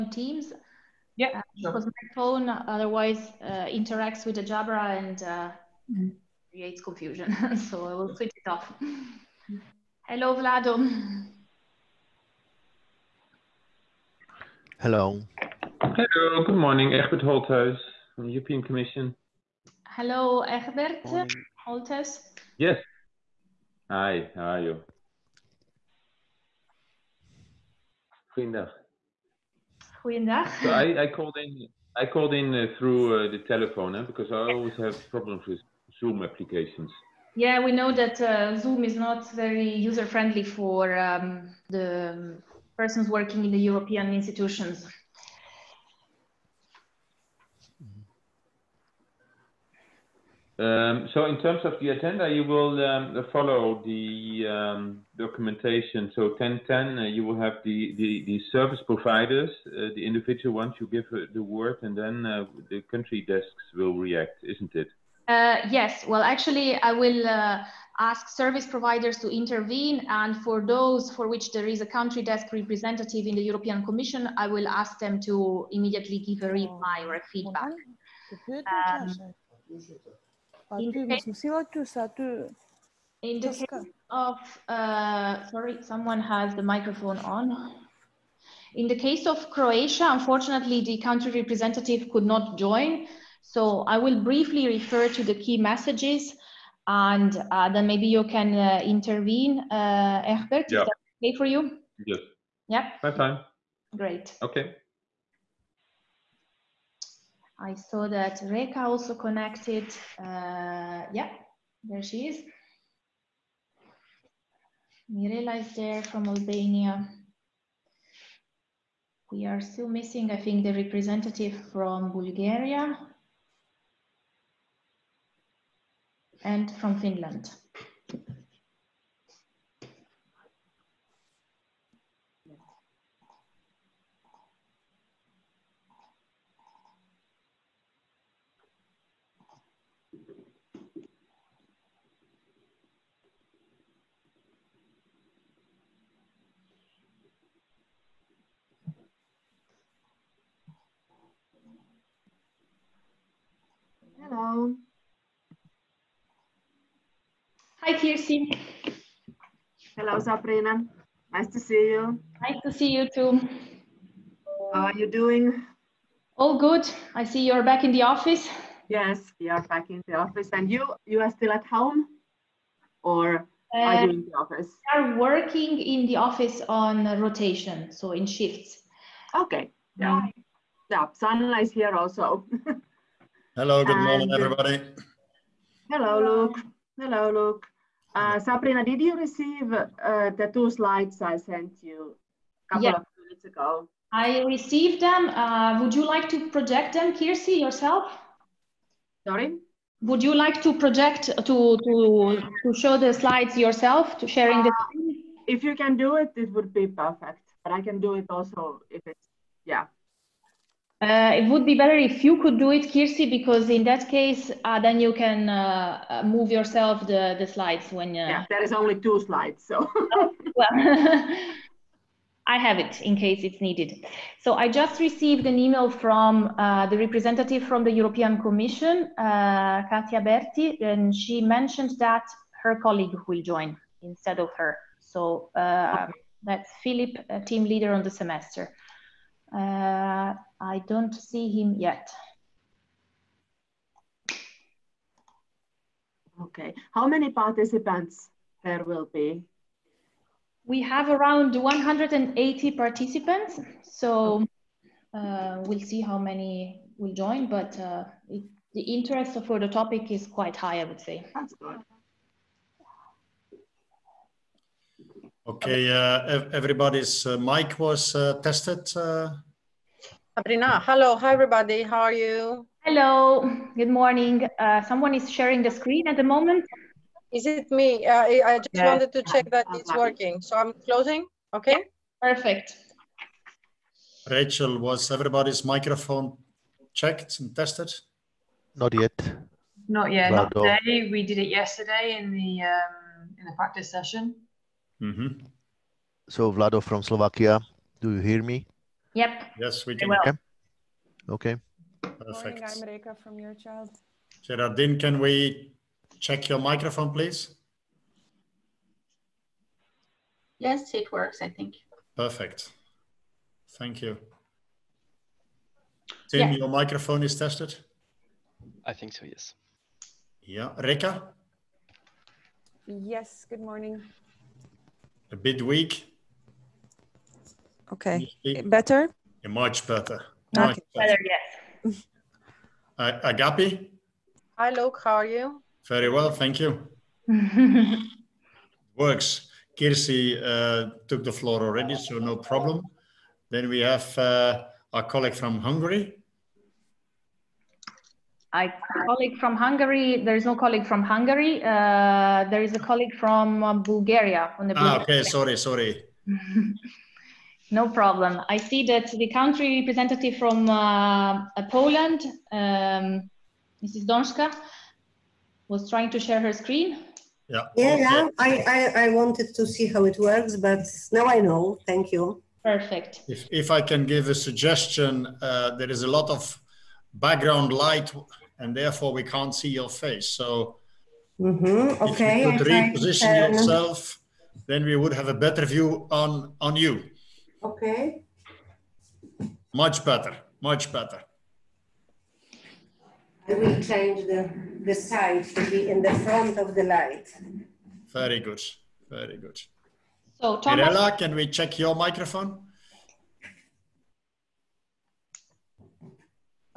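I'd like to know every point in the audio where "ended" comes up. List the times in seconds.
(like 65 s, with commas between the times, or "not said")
not said.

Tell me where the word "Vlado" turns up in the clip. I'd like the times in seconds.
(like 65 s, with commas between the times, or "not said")
10 s, 296 s.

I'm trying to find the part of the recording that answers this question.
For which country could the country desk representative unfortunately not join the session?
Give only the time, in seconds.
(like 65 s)
89 s.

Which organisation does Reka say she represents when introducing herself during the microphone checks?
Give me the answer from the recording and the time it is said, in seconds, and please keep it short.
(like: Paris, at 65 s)
Eurochild, at 303 s.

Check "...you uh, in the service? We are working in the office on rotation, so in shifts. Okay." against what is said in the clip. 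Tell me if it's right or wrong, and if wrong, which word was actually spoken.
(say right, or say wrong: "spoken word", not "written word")
wrong: "office", not "service".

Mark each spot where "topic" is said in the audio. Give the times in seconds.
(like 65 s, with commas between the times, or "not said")
259 s.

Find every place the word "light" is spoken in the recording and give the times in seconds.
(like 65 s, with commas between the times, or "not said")
377 s, 396 s.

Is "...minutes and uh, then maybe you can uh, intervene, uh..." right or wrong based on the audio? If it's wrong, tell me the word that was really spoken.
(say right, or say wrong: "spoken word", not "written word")
wrong: "messages", not "minutes".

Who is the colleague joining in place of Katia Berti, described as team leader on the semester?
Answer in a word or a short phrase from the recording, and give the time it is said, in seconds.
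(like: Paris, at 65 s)
Philip, at 236 s.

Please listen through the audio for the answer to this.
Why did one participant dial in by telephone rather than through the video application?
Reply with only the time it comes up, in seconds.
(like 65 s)
35 s.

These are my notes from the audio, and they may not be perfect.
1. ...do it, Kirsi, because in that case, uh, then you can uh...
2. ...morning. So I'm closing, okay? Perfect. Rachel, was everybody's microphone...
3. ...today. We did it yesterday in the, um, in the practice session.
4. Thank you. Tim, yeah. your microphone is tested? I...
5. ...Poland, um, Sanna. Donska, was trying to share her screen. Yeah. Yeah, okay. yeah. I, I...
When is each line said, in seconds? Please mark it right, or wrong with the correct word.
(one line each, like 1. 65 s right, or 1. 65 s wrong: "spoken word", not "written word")
1. 212 s right
2. 279 s wrong: "working", not "morning"
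3. 290 s right
4. 313 s right
5. 361 s wrong: "Mrs", not "Sanna".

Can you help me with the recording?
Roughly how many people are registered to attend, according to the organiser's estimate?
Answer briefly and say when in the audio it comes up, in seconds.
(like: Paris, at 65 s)
180, at 251 s.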